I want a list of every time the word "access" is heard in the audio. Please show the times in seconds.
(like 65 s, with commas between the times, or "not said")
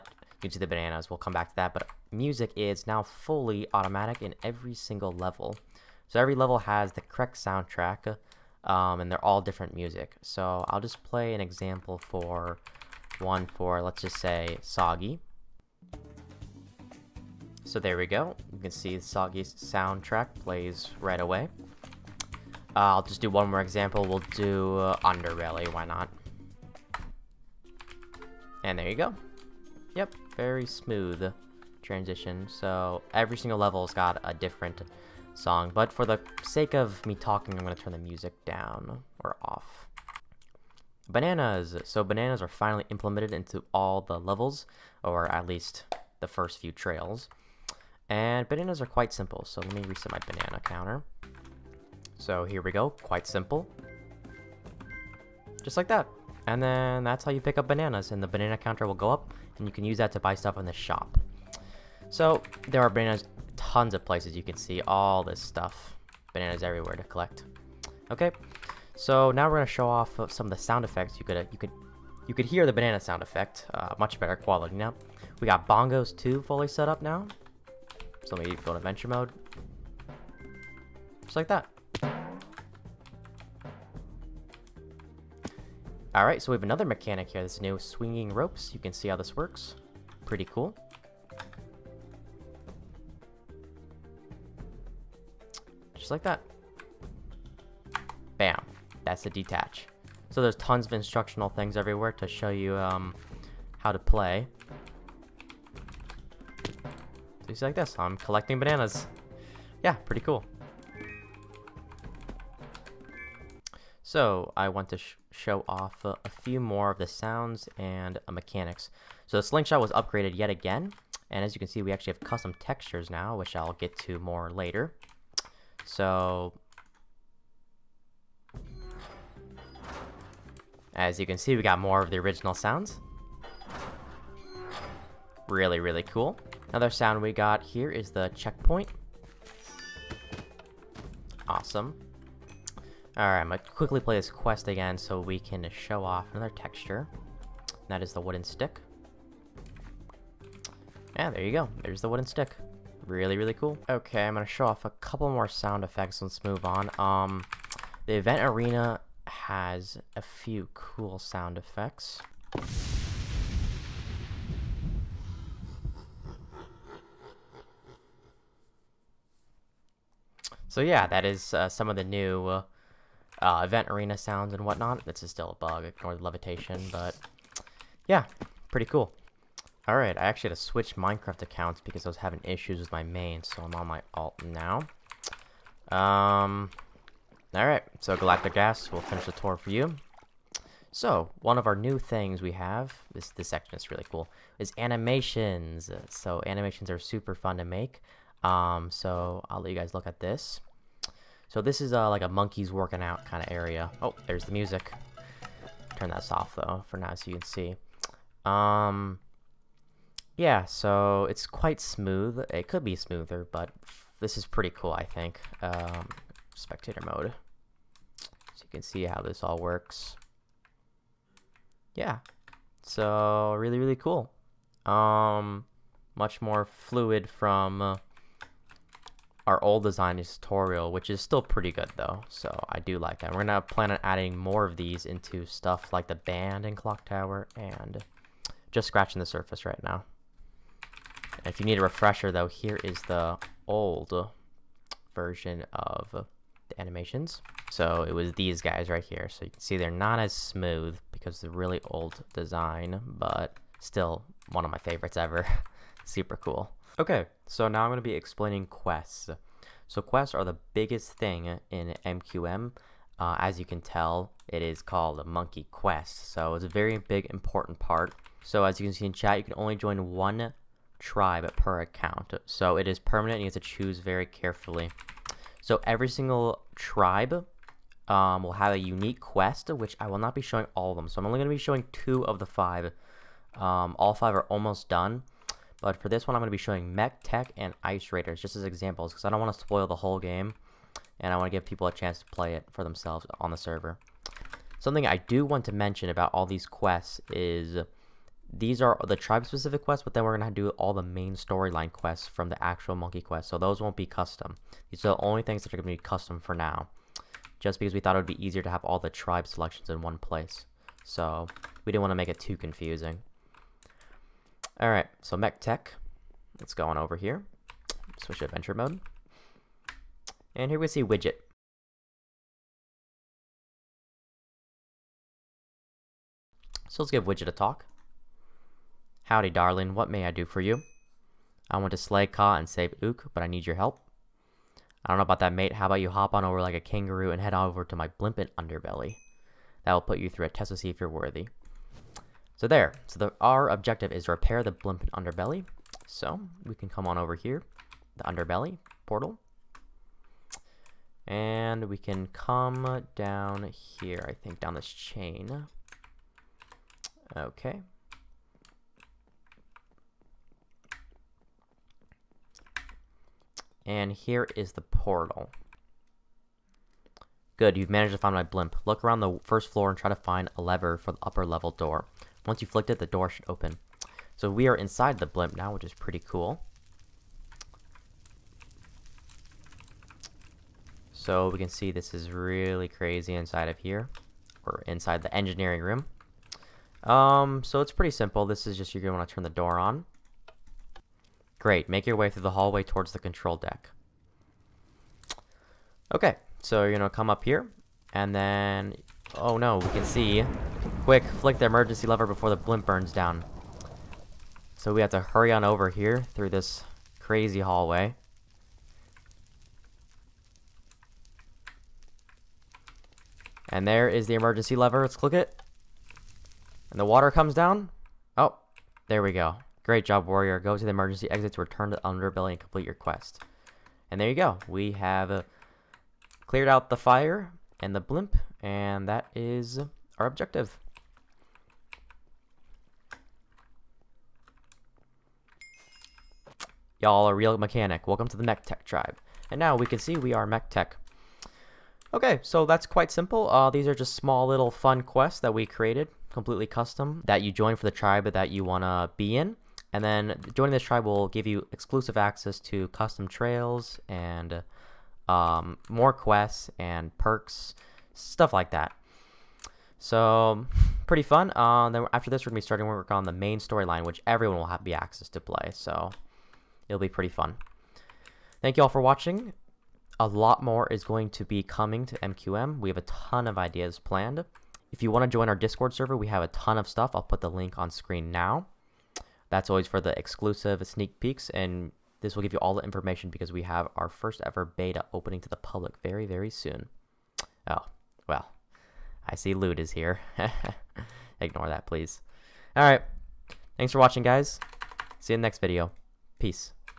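452 s, 464 s.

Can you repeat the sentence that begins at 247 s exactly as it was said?
So it was these guys right here.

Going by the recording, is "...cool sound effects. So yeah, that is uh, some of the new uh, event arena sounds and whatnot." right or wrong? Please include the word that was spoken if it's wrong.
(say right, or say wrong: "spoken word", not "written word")
right.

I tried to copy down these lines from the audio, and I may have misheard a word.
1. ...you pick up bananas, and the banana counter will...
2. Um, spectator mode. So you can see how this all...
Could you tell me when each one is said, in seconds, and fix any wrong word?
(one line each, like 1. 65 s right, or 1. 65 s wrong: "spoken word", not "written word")
1. 57 s right
2. 215 s right.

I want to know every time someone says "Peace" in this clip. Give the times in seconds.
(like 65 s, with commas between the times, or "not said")
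496 s.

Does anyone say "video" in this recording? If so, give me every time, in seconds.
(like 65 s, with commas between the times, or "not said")
495 s.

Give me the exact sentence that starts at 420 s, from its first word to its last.
Go to the emergency exit to return to the underbelly and complete your quest.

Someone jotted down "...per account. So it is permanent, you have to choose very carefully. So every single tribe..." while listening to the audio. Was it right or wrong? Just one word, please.
right.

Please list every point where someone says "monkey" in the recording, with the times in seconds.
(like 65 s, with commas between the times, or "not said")
202 s, 265 s, 302 s.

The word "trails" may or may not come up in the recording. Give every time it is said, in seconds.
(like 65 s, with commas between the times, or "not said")
46 s, 453 s.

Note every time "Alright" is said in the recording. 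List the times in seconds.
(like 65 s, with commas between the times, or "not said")
86 s, 143 s, 179 s, 187 s.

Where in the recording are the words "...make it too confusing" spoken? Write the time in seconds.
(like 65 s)
312 s.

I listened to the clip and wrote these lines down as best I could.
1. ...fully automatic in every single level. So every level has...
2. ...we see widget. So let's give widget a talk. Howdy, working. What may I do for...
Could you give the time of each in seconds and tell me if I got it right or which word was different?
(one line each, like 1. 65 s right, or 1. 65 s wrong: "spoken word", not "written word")
1. 3 s right
2. 320 s wrong: "darling", not "working".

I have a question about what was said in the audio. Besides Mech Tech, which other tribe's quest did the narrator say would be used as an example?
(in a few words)
Ice Raiders.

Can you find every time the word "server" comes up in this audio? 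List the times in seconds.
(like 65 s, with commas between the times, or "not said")
293 s, 475 s.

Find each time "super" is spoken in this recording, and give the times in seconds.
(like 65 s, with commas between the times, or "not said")
196 s, 256 s.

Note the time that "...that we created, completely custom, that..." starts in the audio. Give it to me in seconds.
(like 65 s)
445 s.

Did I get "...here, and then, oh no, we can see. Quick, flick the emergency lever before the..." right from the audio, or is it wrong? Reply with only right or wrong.
right.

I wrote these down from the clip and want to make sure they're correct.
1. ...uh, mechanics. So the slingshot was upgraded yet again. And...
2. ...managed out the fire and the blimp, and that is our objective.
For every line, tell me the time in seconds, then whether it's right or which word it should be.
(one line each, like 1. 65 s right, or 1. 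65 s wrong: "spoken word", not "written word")
1. 118 s right
2. 426 s wrong: "cleared", not "managed".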